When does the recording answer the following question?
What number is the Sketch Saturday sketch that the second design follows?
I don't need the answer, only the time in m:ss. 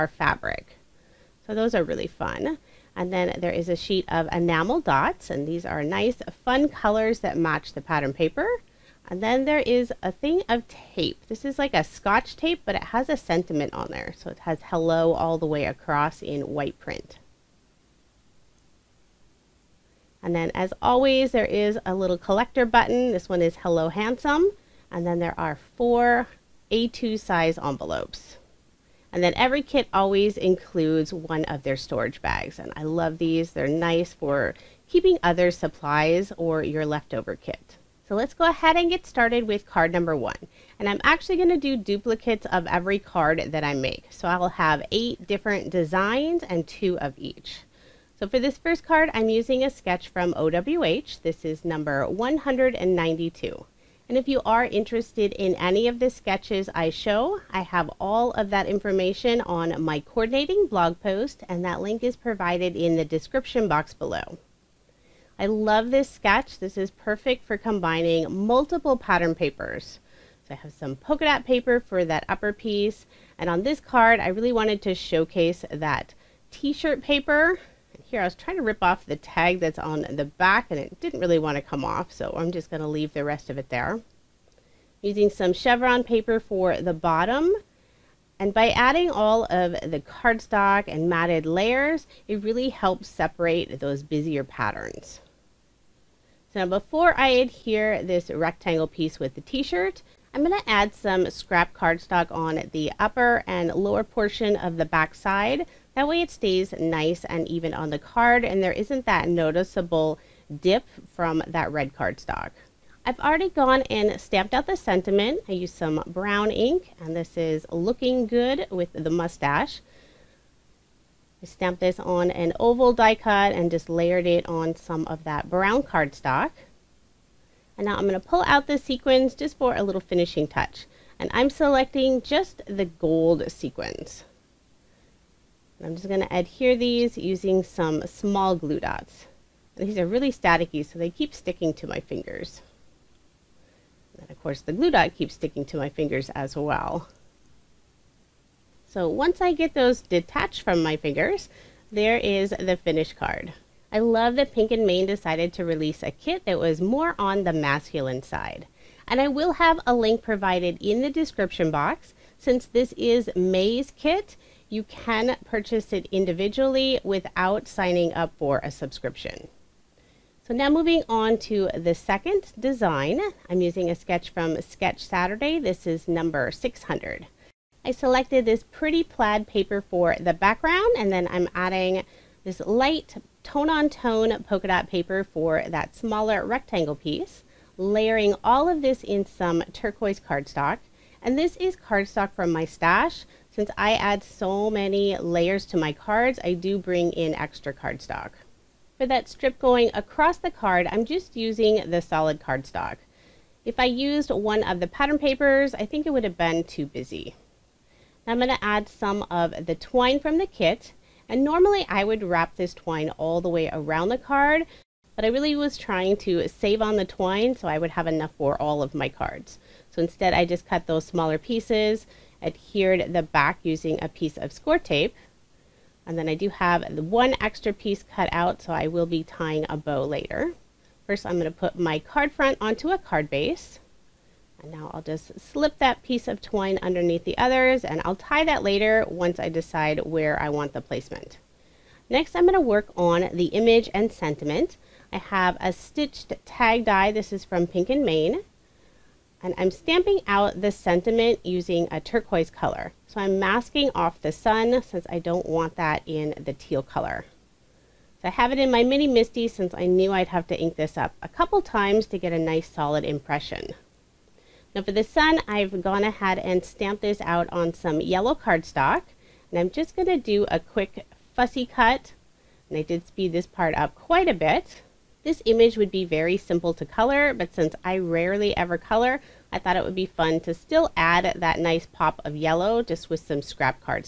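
2:56.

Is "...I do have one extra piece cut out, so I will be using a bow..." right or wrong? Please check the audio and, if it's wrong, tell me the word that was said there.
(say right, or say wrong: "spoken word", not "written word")
wrong: "tying", not "using".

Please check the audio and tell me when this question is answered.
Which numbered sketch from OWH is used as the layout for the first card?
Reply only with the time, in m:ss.
0:52.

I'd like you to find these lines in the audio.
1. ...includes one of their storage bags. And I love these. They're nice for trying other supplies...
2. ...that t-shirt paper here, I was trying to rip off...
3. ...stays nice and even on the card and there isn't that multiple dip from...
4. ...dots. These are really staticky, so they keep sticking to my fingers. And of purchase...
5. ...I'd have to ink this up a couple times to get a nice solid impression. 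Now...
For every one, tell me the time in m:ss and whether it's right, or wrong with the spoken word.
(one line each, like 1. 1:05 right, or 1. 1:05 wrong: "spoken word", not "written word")
1. 0:30 wrong: "keeping", not "trying"
2. 1:15 right
3. 1:46 wrong: "noticeable", not "multiple"
4. 2:18 wrong: "course", not "purchase"
5. 4:20 right.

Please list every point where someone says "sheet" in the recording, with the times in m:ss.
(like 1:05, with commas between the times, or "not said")
0:03.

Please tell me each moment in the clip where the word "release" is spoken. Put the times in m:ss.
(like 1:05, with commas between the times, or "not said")
2:35.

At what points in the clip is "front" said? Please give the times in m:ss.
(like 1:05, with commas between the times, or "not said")
3:52.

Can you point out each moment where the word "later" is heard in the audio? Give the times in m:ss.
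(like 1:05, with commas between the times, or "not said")
3:50, 3:58.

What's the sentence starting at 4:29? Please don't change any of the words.
And I'm just going to do a quick fussy cut.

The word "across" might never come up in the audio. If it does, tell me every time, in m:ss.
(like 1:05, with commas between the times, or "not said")
0:15, 3:19.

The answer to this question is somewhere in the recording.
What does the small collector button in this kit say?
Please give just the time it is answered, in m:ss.
0:23.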